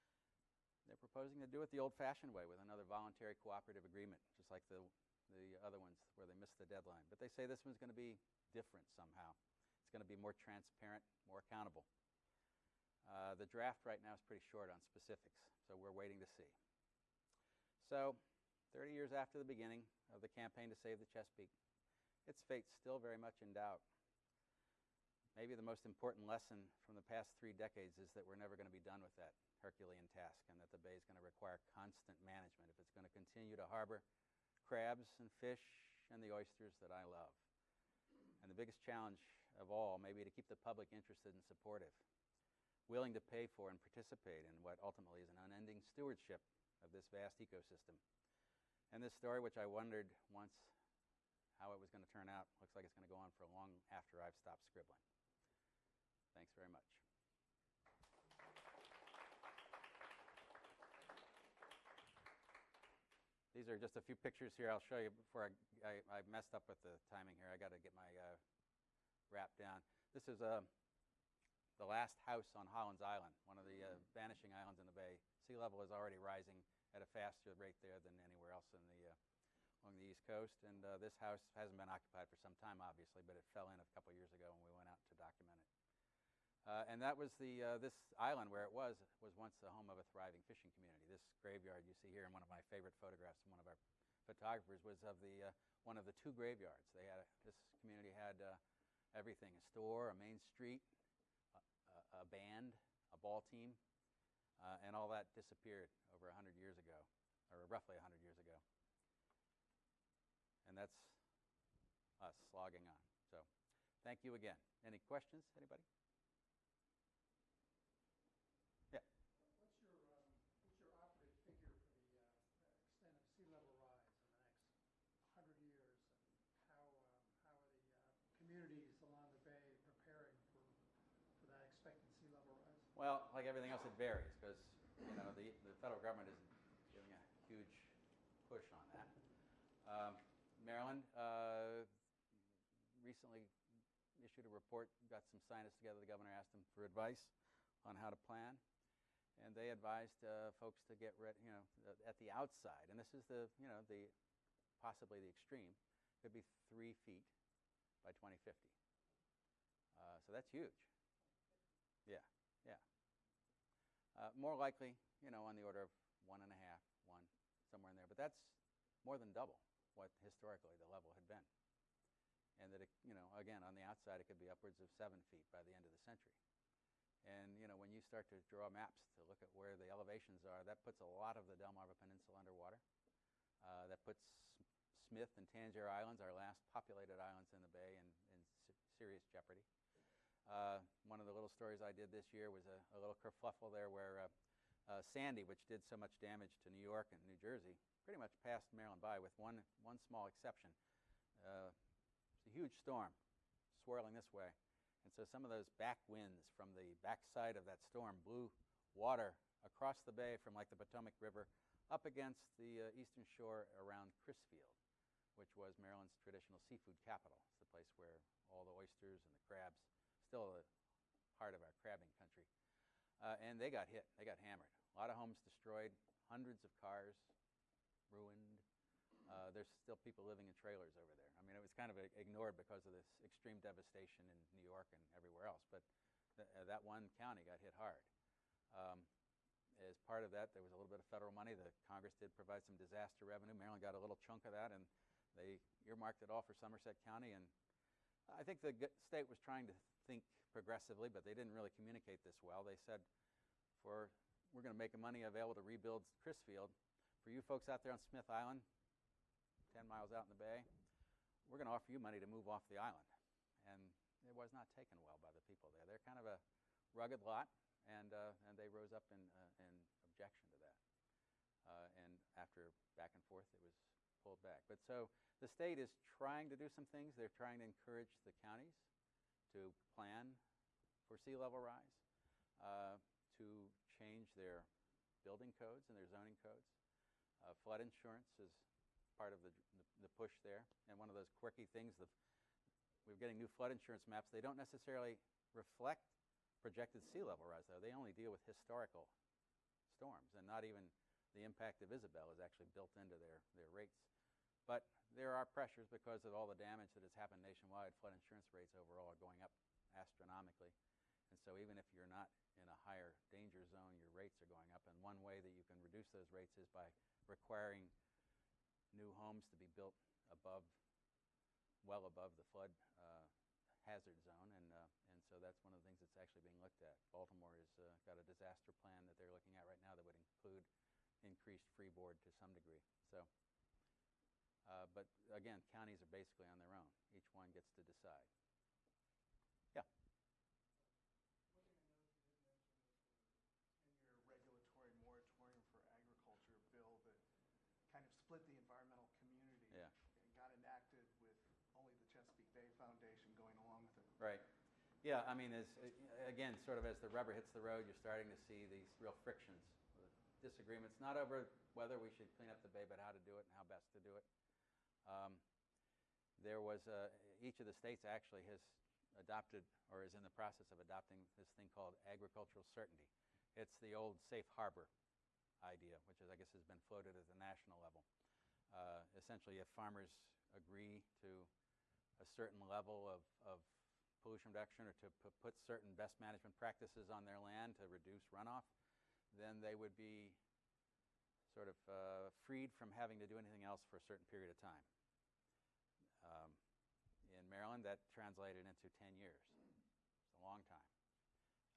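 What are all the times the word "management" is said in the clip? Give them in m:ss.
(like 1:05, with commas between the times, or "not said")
0:32, 6:26.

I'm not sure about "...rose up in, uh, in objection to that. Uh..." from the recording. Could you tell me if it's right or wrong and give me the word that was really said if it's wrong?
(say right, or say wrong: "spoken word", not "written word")
right.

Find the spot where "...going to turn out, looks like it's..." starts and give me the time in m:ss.
0:51.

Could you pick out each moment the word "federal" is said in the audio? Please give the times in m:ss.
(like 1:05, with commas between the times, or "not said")
2:15, 4:01.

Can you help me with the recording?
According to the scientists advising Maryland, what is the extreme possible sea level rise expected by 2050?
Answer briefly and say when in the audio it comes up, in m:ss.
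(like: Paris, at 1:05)
3 feet, at 2:36.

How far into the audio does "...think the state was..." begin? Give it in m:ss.
4:08.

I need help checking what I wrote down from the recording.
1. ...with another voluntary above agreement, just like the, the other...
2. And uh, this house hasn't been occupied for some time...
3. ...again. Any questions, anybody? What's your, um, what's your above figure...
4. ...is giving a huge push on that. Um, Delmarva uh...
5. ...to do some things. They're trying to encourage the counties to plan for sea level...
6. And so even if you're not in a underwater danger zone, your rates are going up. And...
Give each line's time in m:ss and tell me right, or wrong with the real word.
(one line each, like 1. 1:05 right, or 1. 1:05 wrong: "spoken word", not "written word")
1. 0:02 wrong: "cooperative", not "above"
2. 1:20 right
3. 1:54 wrong: "operative", not "above"
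4. 2:16 wrong: "Maryland", not "Delmarva"
5. 4:36 right
6. 5:11 wrong: "higher", not "underwater".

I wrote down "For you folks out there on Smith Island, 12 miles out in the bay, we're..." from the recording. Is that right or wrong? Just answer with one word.
wrong.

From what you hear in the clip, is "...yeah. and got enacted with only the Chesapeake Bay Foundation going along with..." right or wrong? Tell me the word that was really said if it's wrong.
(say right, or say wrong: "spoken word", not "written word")
right.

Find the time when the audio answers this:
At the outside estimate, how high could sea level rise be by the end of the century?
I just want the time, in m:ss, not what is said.
2:54.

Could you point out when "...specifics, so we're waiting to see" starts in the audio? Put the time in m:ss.
0:14.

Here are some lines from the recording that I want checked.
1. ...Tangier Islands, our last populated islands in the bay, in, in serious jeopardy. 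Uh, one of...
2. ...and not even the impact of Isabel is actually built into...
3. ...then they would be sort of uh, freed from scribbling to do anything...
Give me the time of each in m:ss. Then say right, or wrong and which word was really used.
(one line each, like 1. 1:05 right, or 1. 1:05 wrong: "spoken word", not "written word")
1. 3:05 right
2. 5:00 right
3. 6:29 wrong: "having", not "scribbling".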